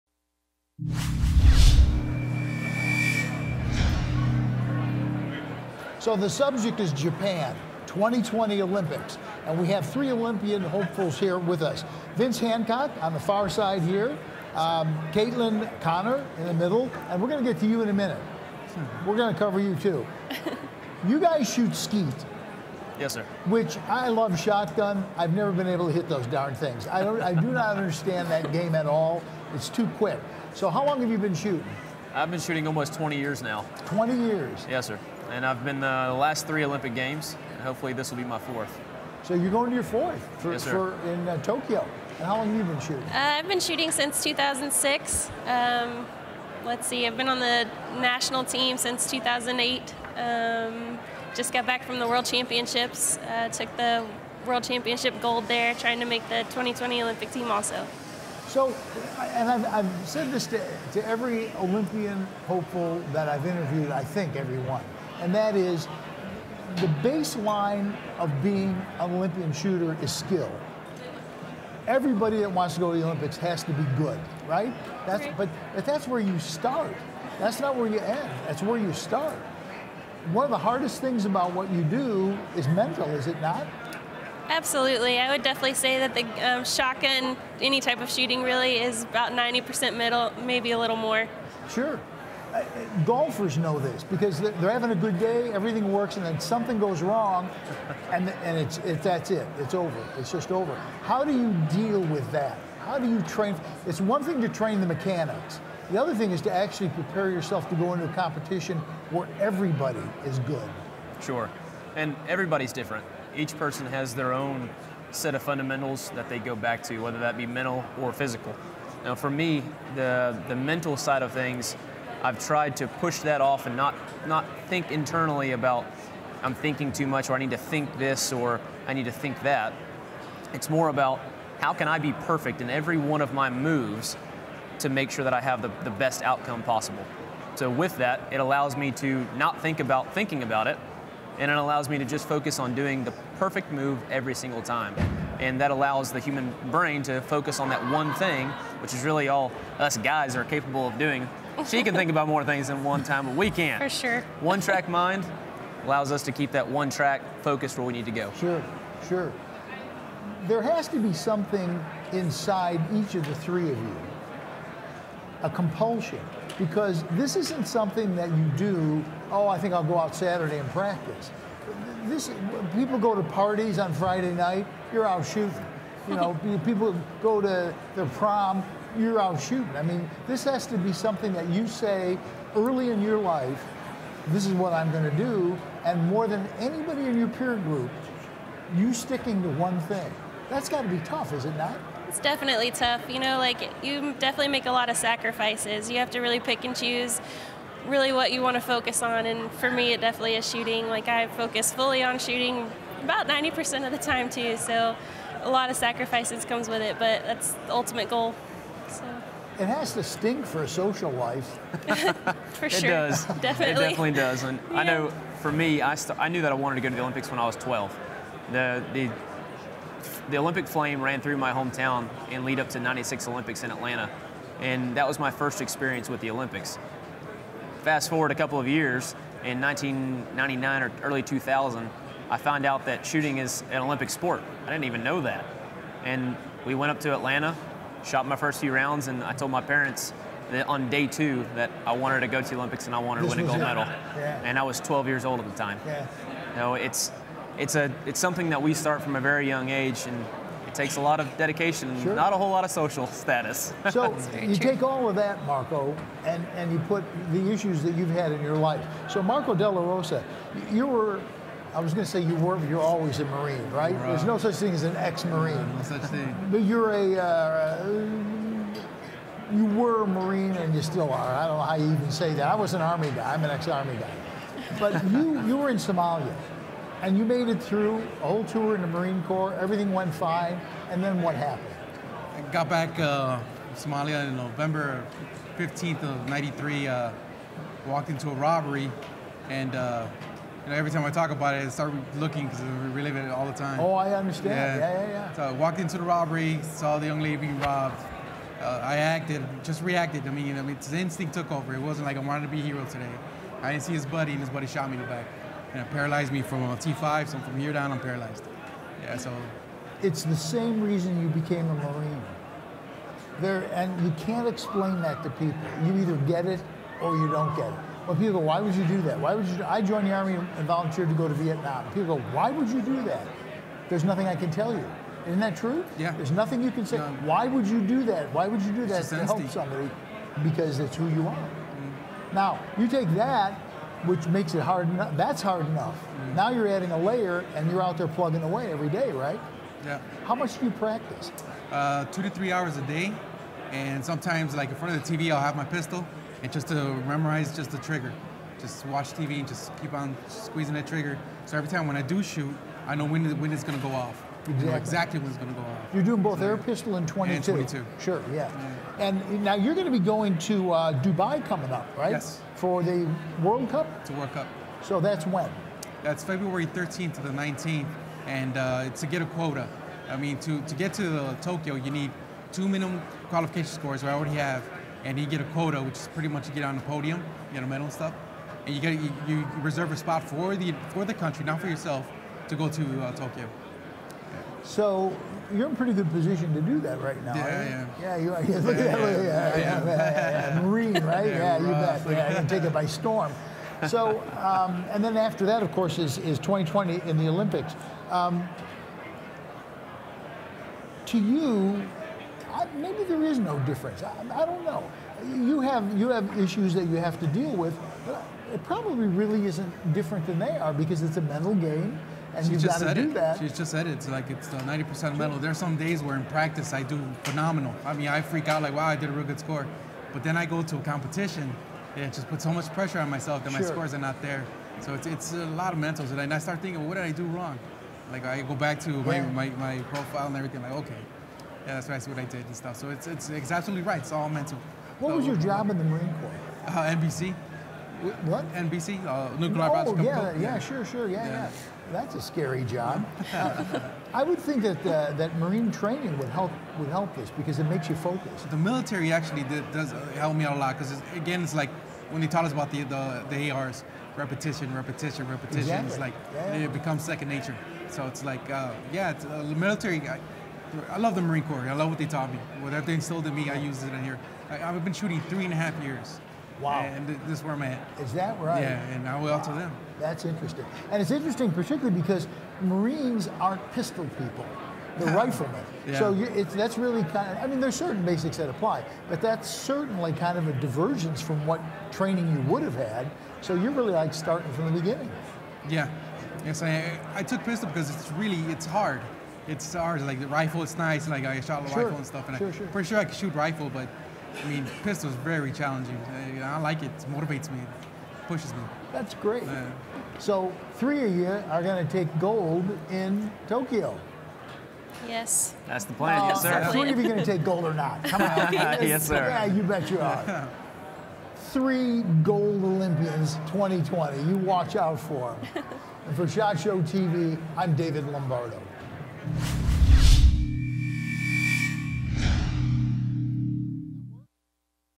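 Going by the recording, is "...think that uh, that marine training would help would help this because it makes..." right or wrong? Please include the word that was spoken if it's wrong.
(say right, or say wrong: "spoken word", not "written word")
right.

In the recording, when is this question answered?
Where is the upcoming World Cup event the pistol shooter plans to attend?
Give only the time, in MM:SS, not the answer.
06:01.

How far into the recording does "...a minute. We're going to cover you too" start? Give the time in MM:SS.
00:17.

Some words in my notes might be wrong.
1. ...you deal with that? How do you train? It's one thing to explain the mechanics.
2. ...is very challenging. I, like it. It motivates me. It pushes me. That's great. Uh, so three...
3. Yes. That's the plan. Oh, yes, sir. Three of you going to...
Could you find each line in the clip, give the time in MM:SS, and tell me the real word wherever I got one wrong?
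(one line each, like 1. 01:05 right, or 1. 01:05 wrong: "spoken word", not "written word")
1. 01:41 wrong: "train", not "explain"
2. 08:15 right
3. 08:25 right.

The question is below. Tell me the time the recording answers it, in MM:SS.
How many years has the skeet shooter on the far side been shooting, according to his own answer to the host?
00:32.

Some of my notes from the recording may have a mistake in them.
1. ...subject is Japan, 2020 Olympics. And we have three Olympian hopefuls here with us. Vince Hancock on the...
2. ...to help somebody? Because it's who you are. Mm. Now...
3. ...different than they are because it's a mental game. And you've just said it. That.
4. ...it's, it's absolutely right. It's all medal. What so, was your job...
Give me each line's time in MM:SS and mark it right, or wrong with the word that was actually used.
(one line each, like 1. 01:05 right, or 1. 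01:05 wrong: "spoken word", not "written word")
1. 00:06 right
2. 05:29 right
3. 06:49 right
4. 07:13 wrong: "mental", not "medal".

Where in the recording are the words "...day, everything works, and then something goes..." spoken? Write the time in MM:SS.
01:35.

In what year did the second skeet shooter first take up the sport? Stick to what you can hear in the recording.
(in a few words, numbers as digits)
2006.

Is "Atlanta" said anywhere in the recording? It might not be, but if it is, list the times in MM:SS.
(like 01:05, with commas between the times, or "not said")
03:43, 03:57.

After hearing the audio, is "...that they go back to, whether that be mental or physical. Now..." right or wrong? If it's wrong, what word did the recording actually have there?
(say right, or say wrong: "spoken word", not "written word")
right.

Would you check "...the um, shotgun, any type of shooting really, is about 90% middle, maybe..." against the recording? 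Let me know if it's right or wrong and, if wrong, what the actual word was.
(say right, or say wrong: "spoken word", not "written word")
right.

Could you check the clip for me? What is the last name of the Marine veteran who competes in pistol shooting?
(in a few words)
DeLaRosa.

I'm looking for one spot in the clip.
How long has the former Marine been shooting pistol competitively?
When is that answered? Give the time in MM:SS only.
07:45.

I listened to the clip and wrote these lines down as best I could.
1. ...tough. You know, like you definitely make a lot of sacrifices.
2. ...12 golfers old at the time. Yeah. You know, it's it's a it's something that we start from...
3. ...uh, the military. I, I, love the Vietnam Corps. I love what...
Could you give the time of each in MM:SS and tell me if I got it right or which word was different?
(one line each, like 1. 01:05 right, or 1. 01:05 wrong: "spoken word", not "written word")
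1. 03:12 right
2. 04:04 wrong: "years", not "golfers"
3. 07:39 wrong: "Marine", not "Vietnam".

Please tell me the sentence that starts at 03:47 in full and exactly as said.
Fast forward a couple of years, in 1999 or early 2000, I found out that shooting is an Olympic sport.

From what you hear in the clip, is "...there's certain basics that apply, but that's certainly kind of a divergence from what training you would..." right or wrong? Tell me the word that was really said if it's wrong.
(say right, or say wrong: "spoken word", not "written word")
right.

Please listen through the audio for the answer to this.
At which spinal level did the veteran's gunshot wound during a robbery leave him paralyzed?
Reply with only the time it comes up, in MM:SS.
05:06.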